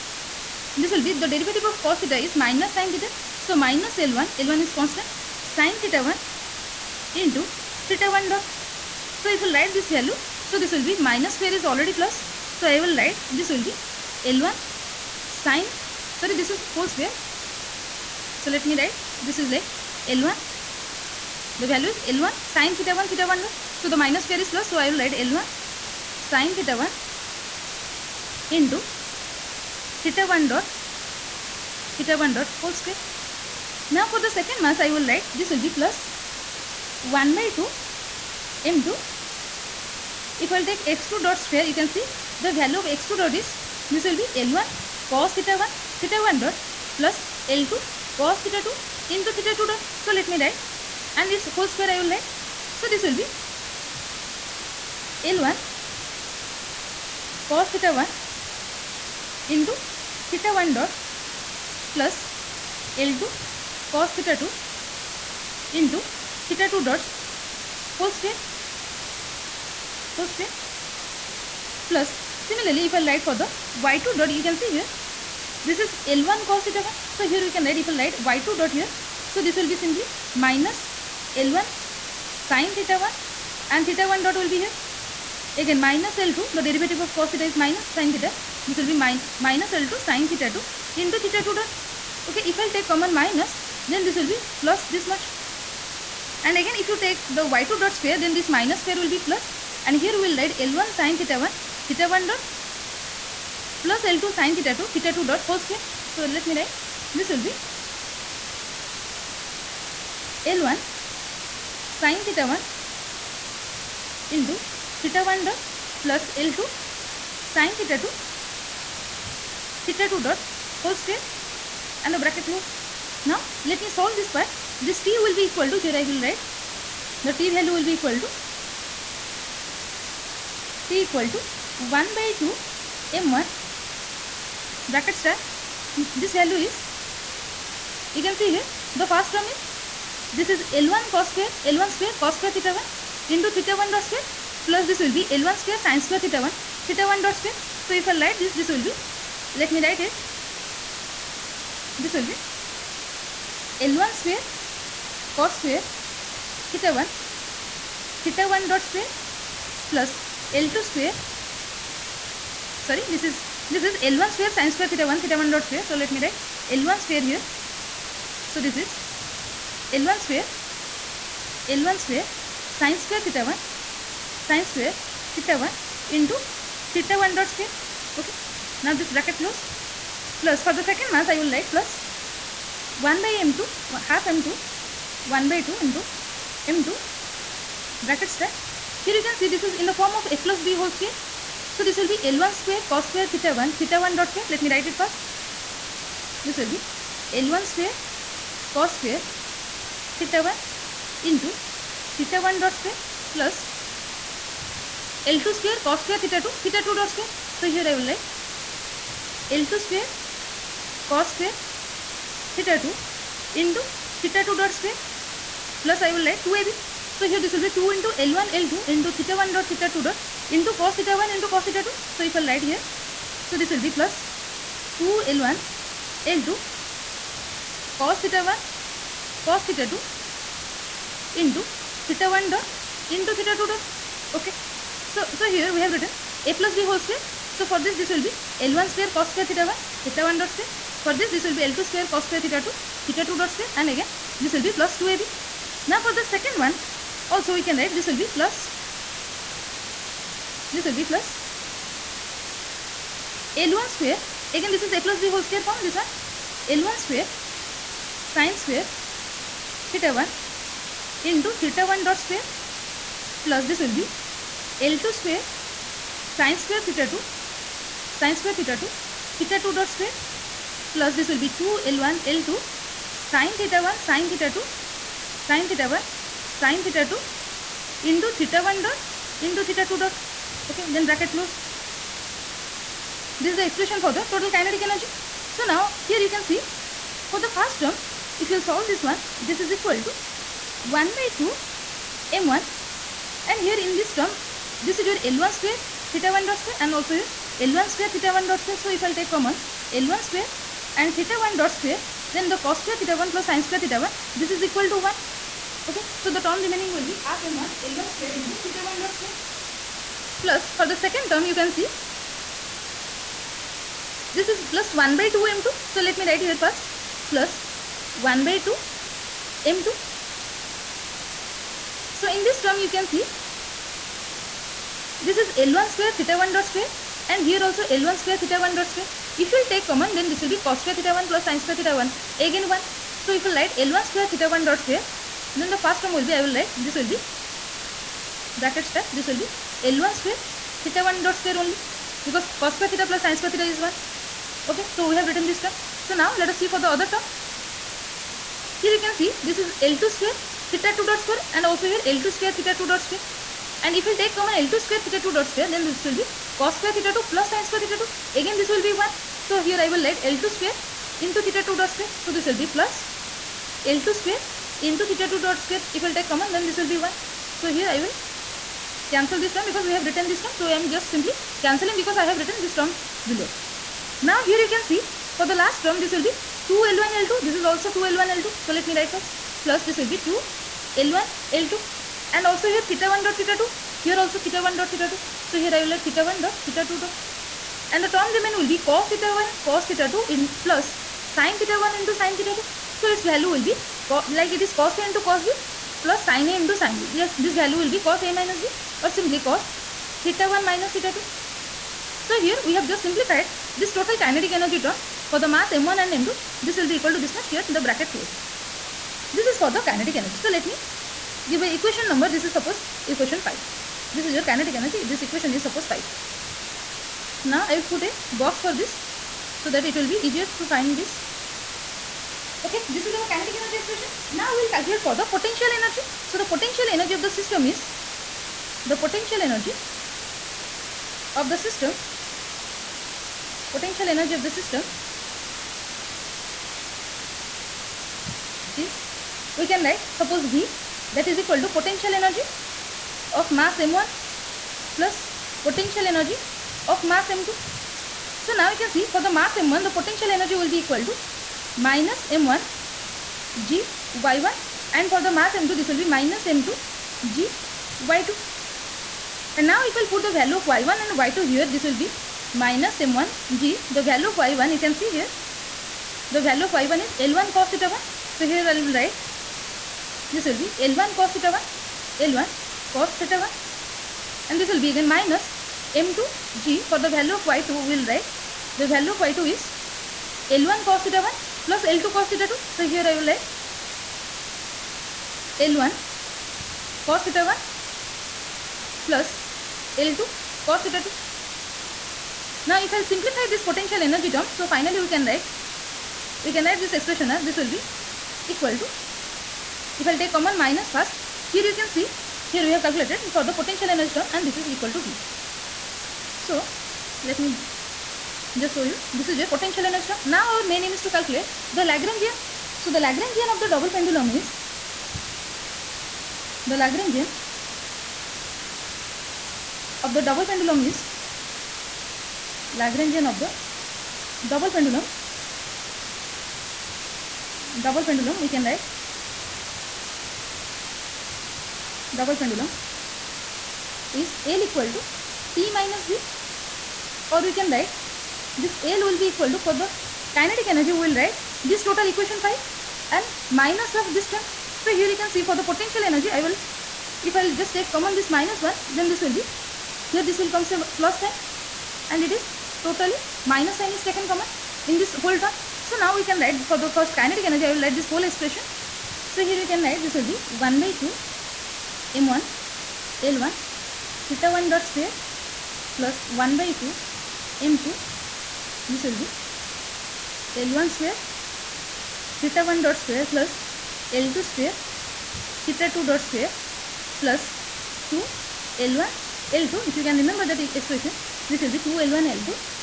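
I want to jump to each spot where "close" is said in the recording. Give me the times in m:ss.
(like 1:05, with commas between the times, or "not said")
2:02, 2:59, 4:41, 6:48.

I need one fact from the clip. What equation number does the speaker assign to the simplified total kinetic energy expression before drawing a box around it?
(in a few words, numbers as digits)
5.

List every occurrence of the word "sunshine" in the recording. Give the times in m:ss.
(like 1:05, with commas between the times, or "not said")
not said.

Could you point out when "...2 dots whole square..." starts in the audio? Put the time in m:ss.
1:06.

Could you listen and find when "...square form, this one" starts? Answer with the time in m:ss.
4:15.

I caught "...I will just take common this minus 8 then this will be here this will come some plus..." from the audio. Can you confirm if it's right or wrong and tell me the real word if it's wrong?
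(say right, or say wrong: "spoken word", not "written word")
wrong: "1", not "8".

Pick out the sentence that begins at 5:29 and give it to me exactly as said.
If you will take common then this will be cos square theta 1 plus sin square theta 1 again 1.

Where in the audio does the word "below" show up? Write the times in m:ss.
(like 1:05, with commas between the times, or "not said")
6:13.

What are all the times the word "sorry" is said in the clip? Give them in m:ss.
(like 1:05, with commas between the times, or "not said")
0:16, 2:42.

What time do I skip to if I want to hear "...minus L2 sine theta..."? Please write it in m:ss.
1:29.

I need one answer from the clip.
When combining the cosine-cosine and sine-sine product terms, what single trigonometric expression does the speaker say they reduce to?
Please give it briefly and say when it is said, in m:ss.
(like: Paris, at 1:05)
cos(theta 1 - theta 2), at 6:39.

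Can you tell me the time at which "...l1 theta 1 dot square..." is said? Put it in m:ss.
9:23.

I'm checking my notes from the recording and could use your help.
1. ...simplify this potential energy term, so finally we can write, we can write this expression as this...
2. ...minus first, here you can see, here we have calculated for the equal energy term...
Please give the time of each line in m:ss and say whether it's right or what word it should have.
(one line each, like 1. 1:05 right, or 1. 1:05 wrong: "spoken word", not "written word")
1. 8:13 right
2. 8:20 wrong: "potential", not "equal".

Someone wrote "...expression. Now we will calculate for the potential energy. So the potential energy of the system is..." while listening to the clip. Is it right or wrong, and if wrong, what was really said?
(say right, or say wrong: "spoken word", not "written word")
right.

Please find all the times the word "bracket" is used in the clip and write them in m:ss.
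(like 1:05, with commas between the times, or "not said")
2:02, 2:14, 2:59, 3:08, 4:41, 5:38, 6:47.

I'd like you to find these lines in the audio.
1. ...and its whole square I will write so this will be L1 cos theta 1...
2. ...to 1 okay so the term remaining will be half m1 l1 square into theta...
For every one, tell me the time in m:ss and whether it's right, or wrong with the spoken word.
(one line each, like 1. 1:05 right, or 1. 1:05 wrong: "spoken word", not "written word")
1. 0:51 right
2. 5:04 right.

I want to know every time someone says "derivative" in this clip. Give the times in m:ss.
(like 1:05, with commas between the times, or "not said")
0:01, 1:26.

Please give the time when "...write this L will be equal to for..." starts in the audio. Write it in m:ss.
8:57.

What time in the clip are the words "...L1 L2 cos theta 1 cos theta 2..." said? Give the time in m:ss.
3:45.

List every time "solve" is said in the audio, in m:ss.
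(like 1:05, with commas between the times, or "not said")
2:03, 4:48.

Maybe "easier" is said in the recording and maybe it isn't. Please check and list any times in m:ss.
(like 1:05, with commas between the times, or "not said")
7:00.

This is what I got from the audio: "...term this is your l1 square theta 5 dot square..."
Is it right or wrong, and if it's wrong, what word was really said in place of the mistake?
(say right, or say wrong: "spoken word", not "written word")
wrong: "1", not "5".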